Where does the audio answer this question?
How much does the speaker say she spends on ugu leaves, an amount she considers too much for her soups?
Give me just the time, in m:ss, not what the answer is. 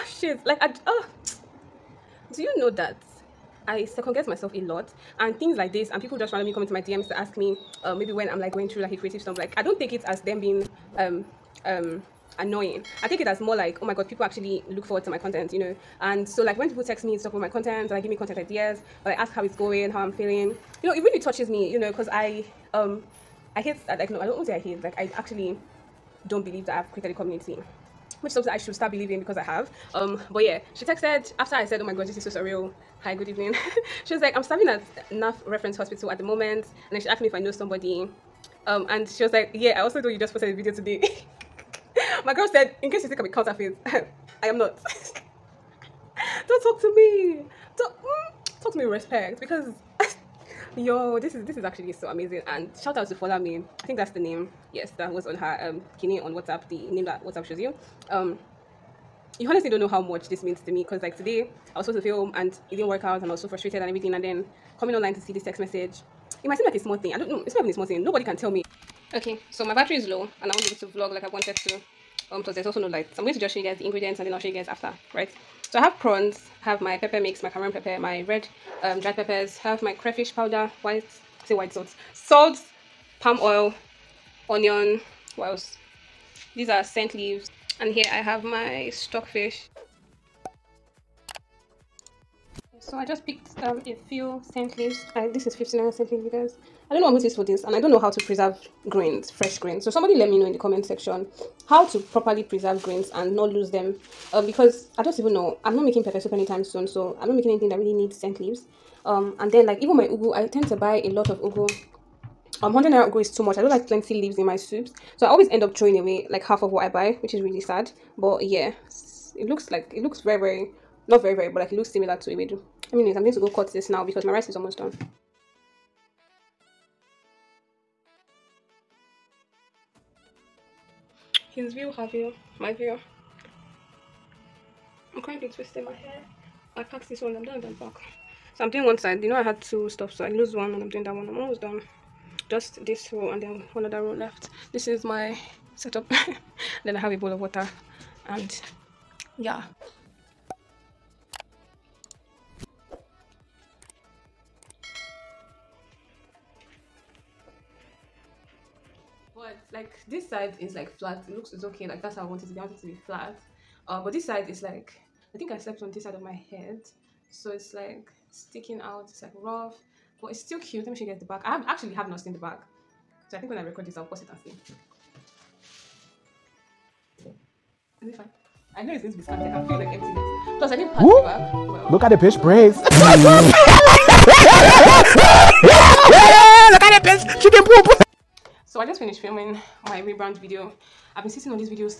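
1:52.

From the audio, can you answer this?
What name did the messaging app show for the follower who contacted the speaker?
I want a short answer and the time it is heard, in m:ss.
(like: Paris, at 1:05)
Follow Me, at 0:53.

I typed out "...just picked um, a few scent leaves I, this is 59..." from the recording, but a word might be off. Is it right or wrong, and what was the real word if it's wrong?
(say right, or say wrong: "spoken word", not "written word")
right.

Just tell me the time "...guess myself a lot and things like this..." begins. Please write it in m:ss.
0:04.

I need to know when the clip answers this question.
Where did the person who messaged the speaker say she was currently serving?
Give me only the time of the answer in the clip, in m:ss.
0:35.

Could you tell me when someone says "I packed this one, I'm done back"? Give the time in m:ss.
2:16.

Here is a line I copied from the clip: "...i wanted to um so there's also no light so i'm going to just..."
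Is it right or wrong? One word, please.
right.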